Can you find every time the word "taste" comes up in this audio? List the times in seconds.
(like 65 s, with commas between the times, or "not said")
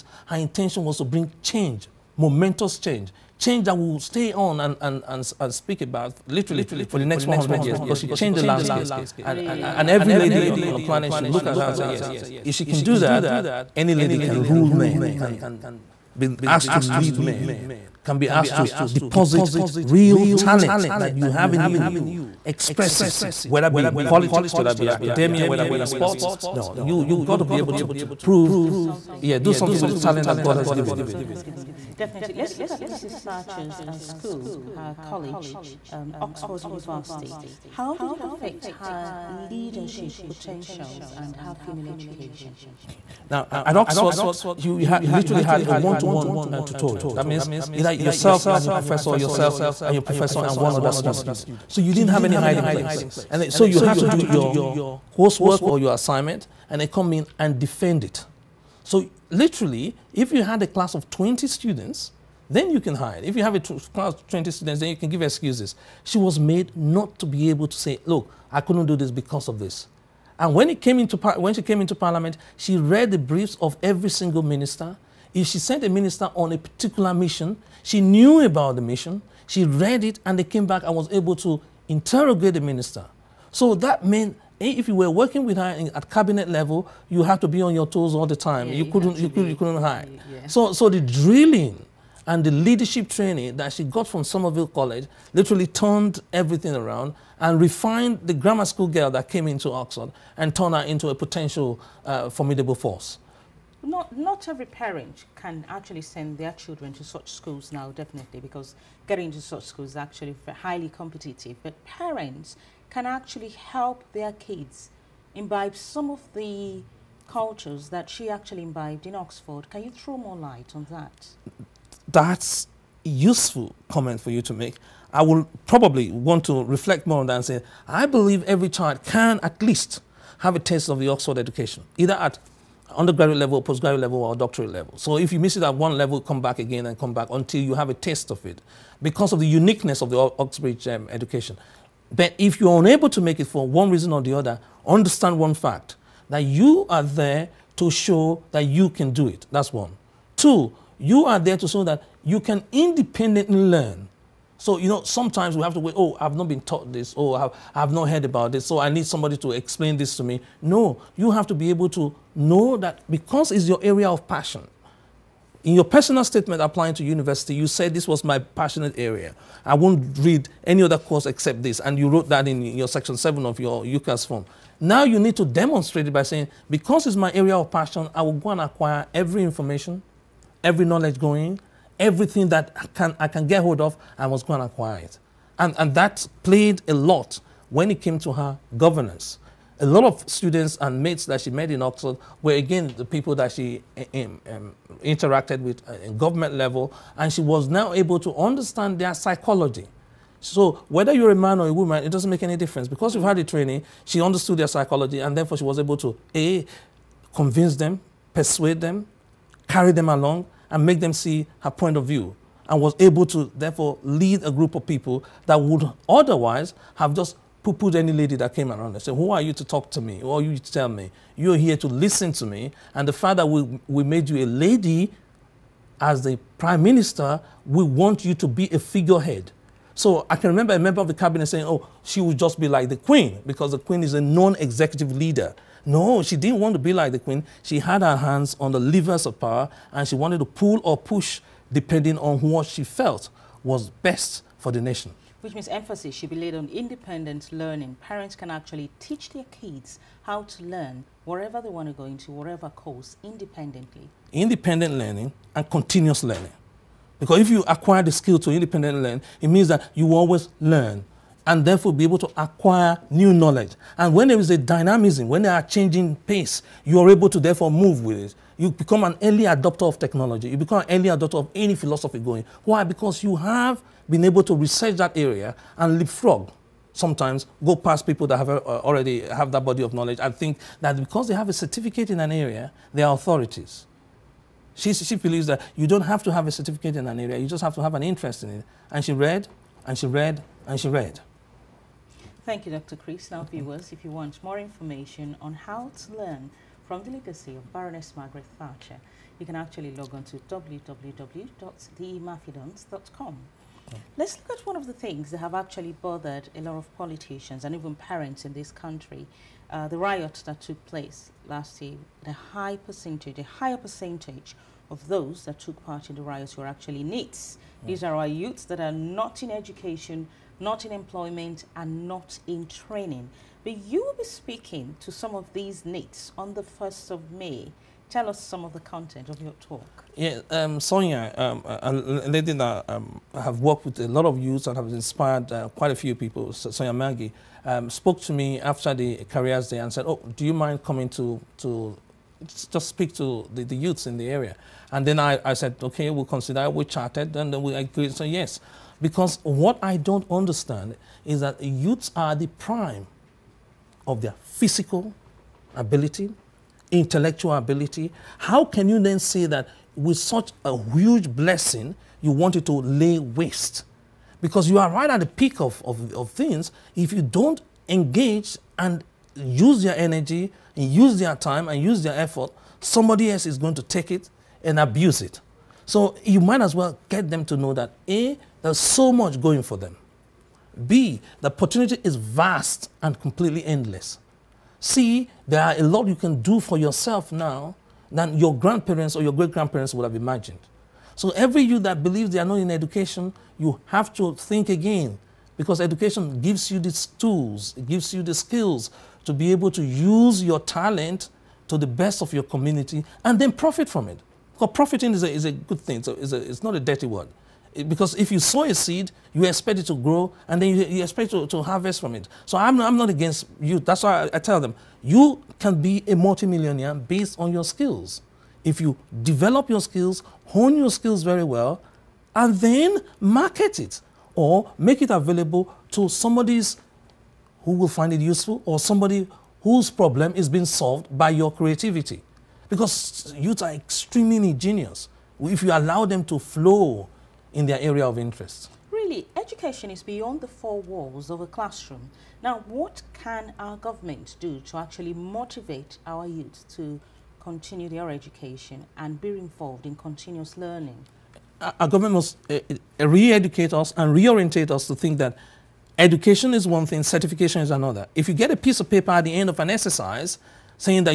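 130 s, 137 s.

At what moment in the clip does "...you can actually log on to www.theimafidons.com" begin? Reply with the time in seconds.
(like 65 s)
299 s.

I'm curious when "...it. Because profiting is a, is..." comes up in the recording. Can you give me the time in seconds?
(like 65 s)
404 s.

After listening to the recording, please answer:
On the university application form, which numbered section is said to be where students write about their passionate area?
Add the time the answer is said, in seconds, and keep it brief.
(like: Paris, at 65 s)
section 7, at 172 s.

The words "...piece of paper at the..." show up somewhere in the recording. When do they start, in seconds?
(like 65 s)
458 s.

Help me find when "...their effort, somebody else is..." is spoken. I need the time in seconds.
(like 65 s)
372 s.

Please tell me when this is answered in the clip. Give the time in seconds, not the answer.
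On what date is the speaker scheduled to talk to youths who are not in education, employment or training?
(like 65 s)
326 s.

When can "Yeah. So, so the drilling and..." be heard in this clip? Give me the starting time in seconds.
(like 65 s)
90 s.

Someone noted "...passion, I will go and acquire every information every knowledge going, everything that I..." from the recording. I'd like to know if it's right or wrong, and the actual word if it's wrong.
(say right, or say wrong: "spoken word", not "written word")
right.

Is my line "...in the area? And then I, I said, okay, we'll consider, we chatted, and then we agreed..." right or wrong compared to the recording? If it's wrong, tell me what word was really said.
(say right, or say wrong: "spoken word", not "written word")
right.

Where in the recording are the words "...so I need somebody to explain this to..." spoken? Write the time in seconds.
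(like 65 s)
158 s.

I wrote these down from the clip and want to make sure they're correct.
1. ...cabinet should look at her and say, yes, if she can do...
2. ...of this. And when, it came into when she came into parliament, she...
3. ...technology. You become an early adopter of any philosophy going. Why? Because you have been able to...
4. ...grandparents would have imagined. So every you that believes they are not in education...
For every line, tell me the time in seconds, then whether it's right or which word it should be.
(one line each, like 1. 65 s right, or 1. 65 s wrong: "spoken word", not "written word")
1. 10 s wrong: "planet", not "cabinet"
2. 69 s right
3. 269 s right
4. 389 s right.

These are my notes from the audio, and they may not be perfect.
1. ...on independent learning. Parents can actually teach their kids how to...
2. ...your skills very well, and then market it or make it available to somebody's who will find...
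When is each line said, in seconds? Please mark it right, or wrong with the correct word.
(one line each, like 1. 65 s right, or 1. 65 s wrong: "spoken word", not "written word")
1. 246 s right
2. 420 s right.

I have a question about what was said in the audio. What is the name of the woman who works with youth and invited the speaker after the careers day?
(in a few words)
Sonia Maggie.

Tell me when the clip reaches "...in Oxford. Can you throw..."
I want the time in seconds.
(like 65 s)
119 s.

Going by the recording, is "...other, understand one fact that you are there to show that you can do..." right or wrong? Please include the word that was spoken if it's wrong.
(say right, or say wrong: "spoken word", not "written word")
right.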